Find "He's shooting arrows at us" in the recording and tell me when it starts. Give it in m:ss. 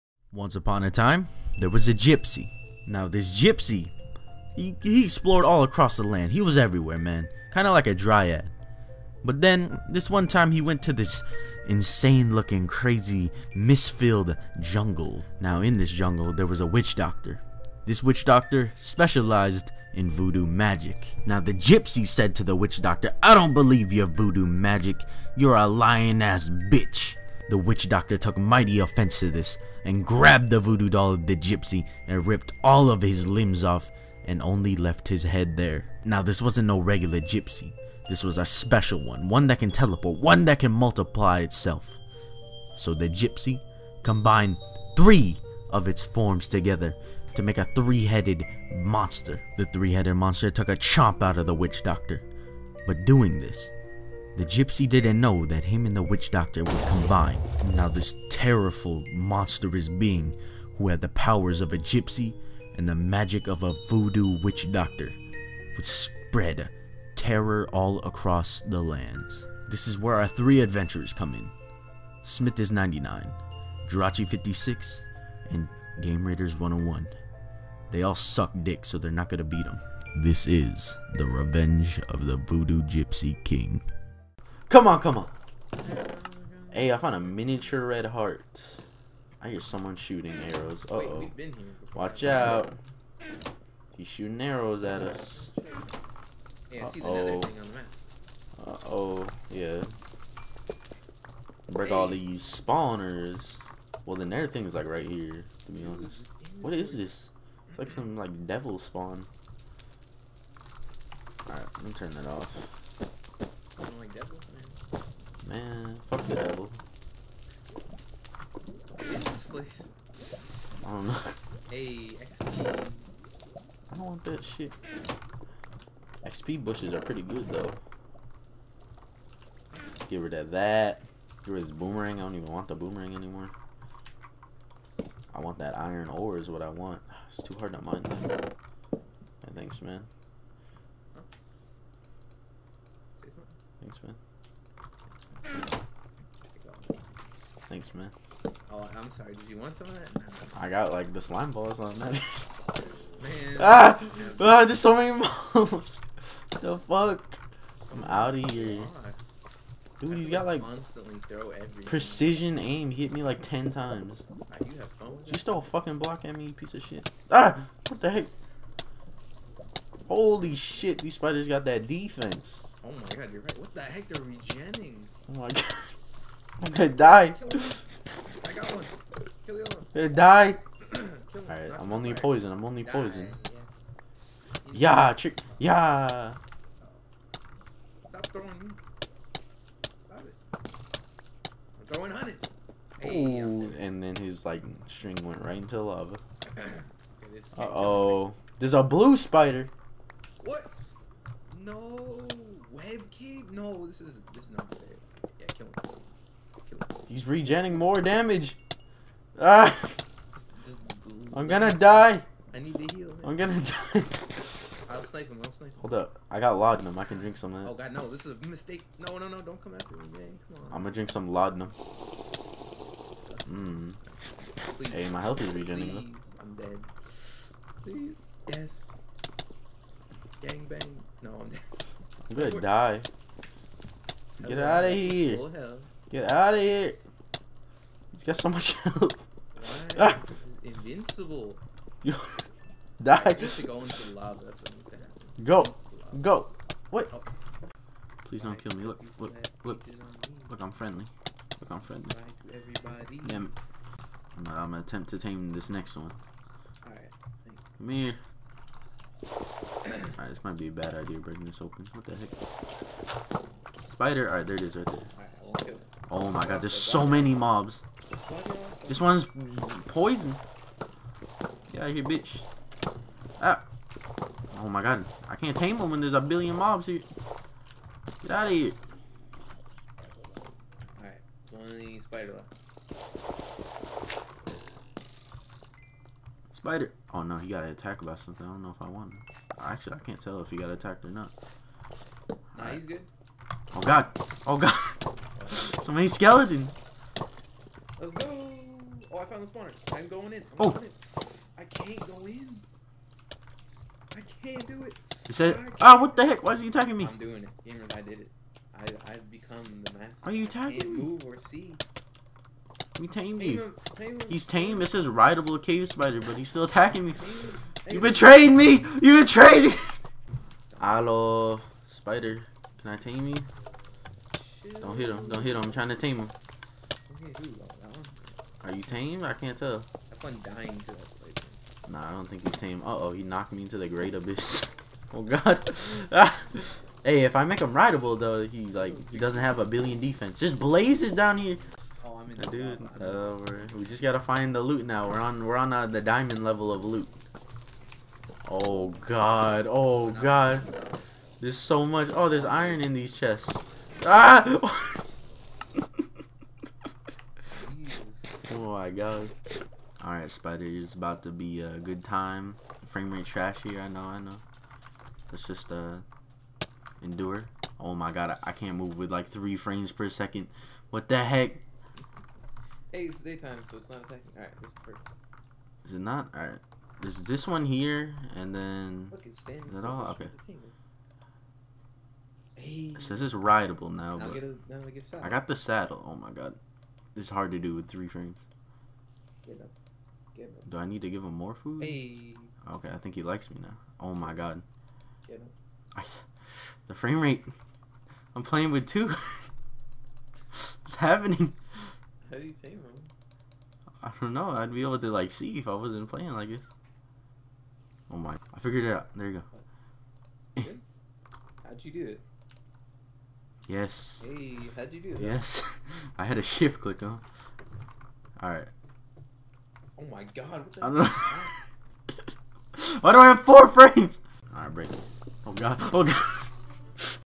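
1:33.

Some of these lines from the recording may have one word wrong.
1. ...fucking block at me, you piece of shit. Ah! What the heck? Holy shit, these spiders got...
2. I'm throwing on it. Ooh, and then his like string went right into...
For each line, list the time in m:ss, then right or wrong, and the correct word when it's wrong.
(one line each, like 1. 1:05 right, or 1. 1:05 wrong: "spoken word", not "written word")
1. 2:45 right
2. 3:11 right.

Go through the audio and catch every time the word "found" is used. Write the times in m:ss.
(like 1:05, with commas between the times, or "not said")
1:26, 4:59.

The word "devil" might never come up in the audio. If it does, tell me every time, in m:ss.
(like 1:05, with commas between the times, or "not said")
1:48, 1:56.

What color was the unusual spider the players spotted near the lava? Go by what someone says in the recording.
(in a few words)
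Blue.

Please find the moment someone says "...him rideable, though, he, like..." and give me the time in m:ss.
5:37.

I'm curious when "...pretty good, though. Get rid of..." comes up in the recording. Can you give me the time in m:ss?
2:07.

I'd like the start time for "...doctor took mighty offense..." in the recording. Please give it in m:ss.
0:27.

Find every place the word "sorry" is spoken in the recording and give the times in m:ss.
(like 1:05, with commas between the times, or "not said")
2:29.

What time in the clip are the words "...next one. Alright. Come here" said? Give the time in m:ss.
4:15.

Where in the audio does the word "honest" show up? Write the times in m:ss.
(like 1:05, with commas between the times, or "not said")
1:45.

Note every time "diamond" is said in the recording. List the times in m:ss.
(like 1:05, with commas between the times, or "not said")
5:46.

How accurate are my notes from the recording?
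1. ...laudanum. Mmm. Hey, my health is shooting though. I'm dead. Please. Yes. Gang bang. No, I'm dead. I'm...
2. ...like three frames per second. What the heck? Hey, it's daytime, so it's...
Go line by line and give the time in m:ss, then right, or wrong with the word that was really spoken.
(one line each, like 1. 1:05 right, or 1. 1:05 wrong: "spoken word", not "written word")
1. 3:41 wrong: "regenerating", not "shooting"
2. 6:09 right.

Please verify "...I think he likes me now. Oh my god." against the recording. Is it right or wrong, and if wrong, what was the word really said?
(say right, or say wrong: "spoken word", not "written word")
right.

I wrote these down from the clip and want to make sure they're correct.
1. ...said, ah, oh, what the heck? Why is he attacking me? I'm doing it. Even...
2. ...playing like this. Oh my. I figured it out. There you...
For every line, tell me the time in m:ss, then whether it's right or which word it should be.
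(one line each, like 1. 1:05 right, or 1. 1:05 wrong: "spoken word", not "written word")
1. 5:05 right
2. 6:46 right.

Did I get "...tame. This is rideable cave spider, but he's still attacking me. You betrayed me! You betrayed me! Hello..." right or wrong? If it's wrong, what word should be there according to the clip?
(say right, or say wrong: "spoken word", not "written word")
right.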